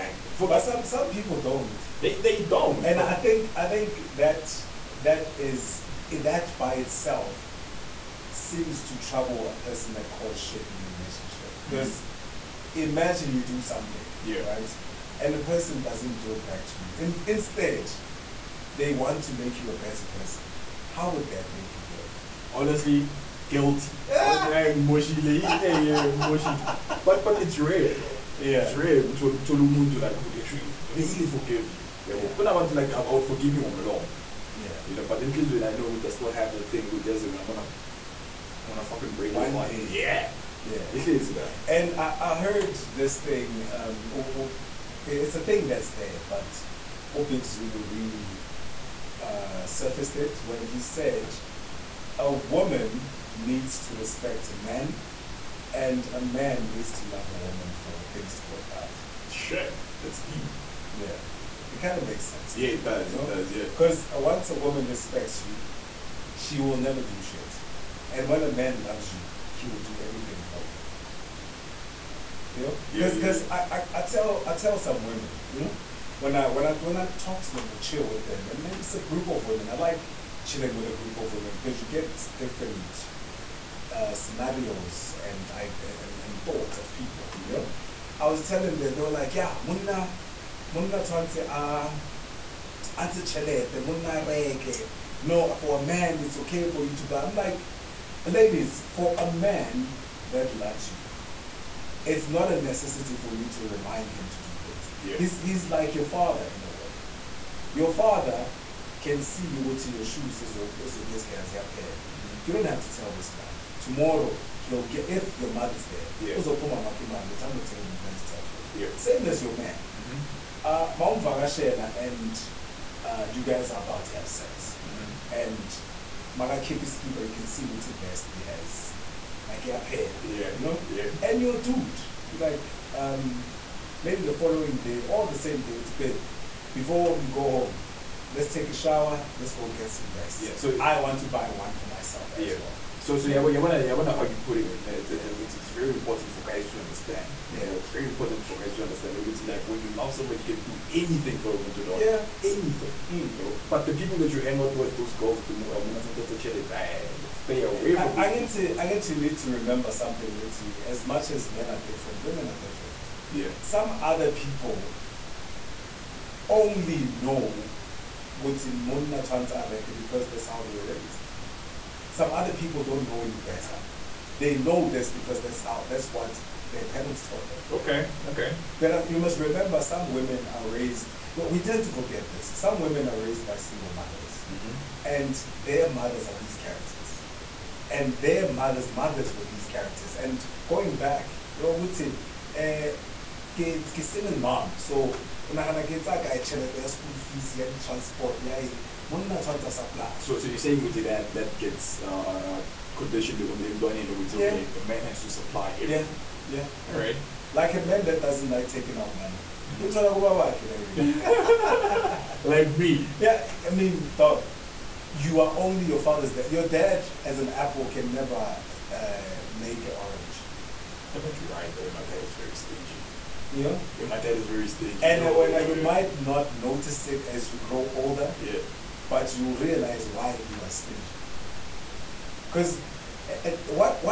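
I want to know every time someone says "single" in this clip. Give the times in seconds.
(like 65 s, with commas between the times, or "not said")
183 s, 194 s.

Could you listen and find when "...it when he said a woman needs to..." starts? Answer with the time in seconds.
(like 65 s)
50 s.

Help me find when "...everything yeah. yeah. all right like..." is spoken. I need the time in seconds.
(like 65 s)
205 s.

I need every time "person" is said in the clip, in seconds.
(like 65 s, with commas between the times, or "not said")
9 s, 15 s, 20 s.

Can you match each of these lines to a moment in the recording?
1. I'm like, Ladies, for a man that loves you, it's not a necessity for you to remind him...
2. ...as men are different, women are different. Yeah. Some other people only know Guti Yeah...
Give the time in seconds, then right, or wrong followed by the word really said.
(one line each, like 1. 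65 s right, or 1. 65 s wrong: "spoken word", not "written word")
1. 97 s right
2. 161 s wrong: "Mona", not "Yeah".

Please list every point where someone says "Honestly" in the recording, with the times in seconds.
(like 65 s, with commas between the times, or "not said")
22 s.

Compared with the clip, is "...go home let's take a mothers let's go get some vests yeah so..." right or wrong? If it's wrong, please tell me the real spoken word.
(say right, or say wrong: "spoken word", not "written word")
wrong: "shower", not "mothers".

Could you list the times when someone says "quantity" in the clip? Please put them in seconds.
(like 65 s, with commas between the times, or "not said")
not said.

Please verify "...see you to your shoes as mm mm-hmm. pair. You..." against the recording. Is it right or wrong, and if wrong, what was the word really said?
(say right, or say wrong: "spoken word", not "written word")
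right.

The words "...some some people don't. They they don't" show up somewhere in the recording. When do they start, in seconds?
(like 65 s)
0 s.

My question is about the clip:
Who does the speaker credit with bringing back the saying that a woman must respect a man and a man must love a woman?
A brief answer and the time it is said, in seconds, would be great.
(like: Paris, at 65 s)
Opik Zulu, at 47 s.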